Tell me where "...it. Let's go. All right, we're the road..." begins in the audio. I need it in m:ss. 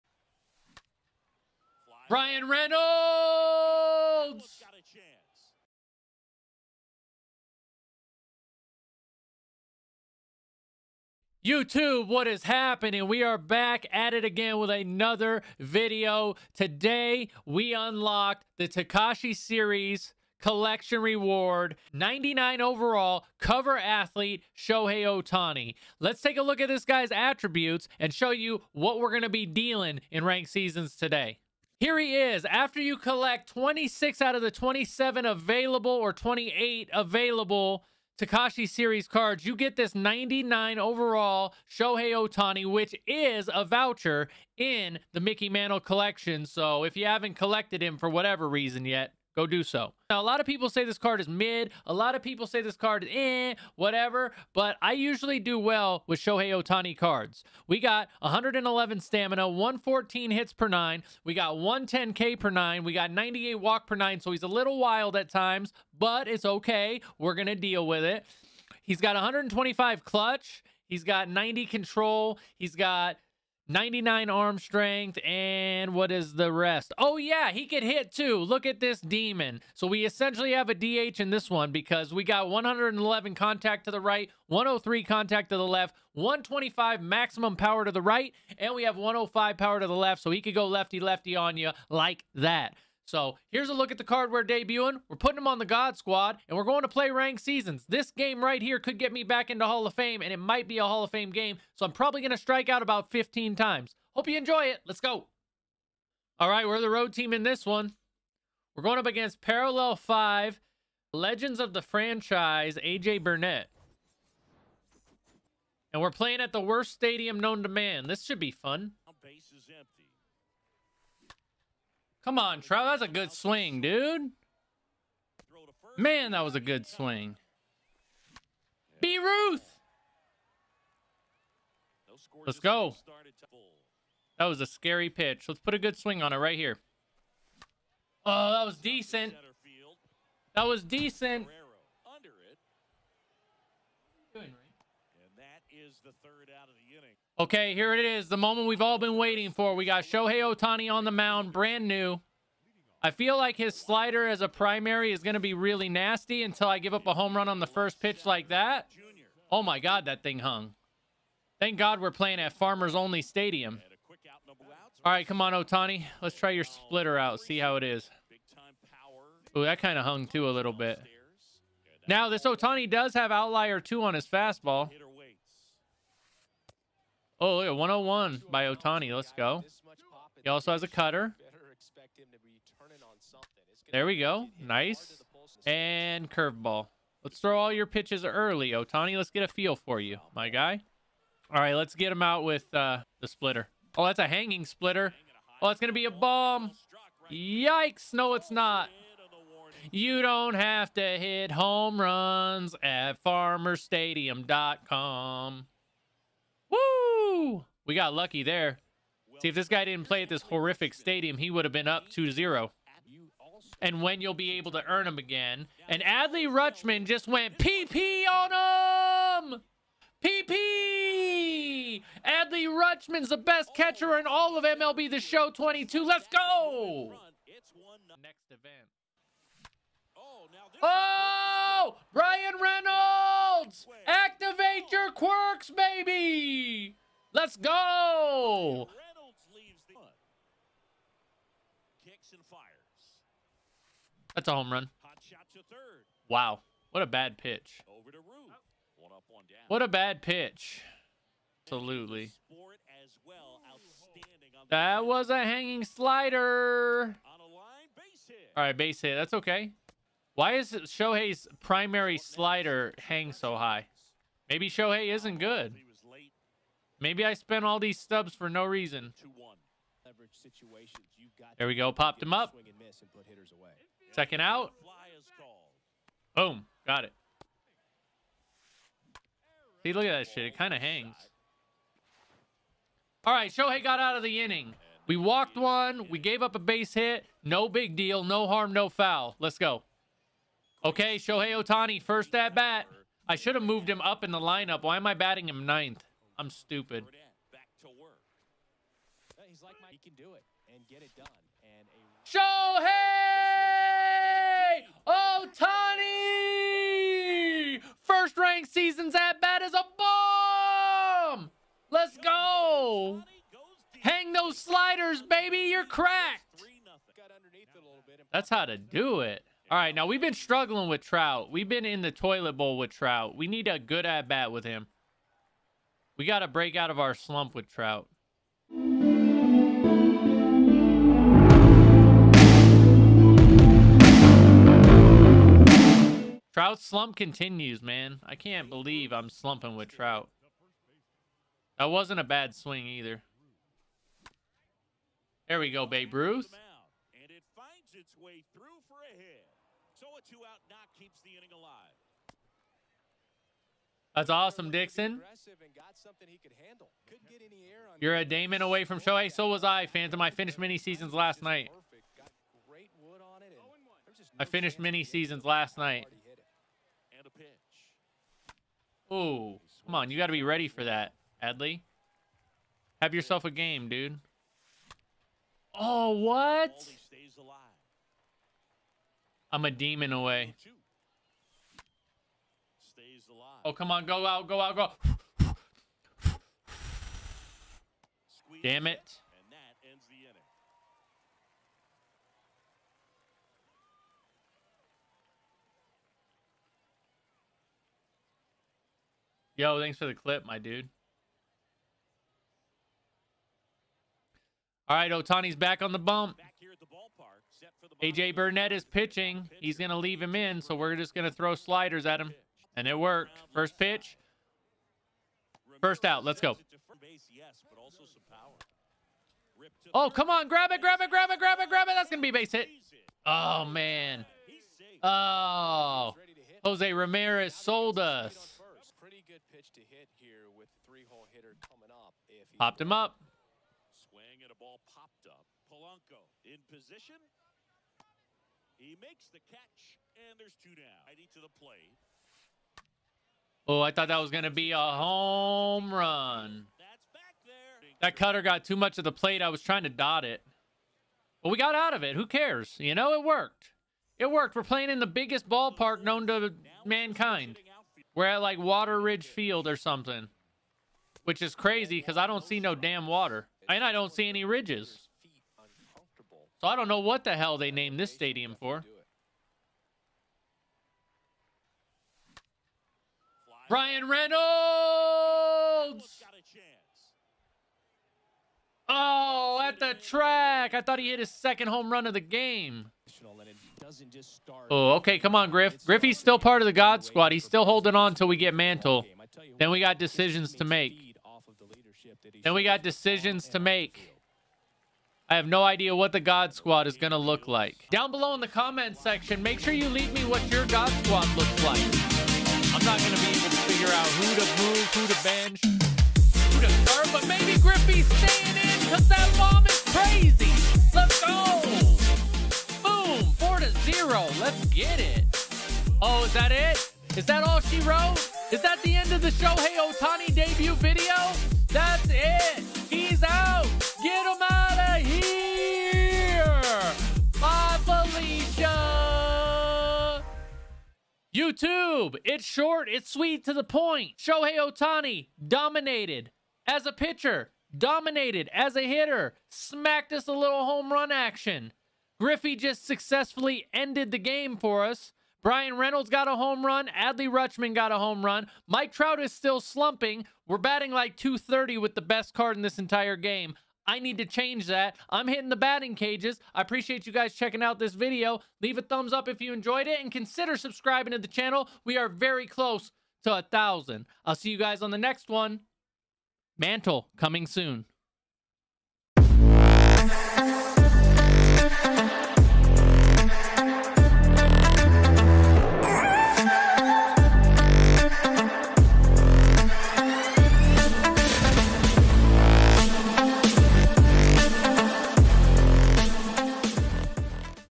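1:44.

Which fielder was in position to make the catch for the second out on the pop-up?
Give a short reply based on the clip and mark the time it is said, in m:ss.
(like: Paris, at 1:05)
Polanco, at 7:15.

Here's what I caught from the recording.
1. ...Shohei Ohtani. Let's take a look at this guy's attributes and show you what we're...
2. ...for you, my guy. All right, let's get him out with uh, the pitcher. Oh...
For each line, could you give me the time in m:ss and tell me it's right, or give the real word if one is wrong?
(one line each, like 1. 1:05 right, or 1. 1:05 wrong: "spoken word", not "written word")
1. 0:24 right
2. 3:09 wrong: "splitter", not "pitcher".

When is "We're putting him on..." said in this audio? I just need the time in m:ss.
1:35.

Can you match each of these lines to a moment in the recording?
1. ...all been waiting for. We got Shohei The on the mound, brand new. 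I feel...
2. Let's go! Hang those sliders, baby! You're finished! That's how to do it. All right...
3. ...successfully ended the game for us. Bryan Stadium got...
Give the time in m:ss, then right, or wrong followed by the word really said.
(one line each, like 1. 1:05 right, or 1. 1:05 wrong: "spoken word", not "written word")
1. 2:28 wrong: "Ohtani", not "The"
2. 5:11 wrong: "cracked", not "finished"
3. 9:02 wrong: "Reynolds", not "Stadium".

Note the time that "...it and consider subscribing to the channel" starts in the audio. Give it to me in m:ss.
9:19.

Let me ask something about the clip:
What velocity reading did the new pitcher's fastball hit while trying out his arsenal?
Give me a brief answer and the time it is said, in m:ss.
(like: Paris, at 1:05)
101, at 2:57.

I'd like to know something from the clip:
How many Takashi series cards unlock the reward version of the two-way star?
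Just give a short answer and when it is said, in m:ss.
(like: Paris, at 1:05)
26, at 0:33.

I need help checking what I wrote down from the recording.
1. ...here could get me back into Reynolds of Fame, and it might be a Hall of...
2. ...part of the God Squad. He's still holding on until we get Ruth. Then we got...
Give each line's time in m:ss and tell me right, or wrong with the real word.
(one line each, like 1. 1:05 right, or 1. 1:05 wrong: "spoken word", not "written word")
1. 1:38 wrong: "Hall", not "Reynolds"
2. 8:06 wrong: "Mantle", not "Ruth".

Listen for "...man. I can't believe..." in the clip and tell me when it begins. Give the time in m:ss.
5:37.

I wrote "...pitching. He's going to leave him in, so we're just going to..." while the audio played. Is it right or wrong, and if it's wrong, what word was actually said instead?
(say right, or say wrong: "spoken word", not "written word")
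right.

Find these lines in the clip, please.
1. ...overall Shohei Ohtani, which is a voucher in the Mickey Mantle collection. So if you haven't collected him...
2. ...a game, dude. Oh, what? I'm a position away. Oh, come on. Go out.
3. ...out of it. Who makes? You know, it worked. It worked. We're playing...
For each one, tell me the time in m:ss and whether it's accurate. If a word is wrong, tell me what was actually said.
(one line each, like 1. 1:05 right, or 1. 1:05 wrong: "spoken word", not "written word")
1. 0:40 right
2. 6:13 wrong: "demon", not "position"
3. 7:31 wrong: "cares", not "makes".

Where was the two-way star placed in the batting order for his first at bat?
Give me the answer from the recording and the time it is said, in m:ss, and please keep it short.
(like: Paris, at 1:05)
Ninth, at 4:55.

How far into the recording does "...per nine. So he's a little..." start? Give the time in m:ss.
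1:03.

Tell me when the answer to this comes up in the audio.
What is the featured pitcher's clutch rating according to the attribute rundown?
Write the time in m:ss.
1:09.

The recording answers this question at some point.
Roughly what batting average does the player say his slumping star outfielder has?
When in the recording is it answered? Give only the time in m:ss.
9:11.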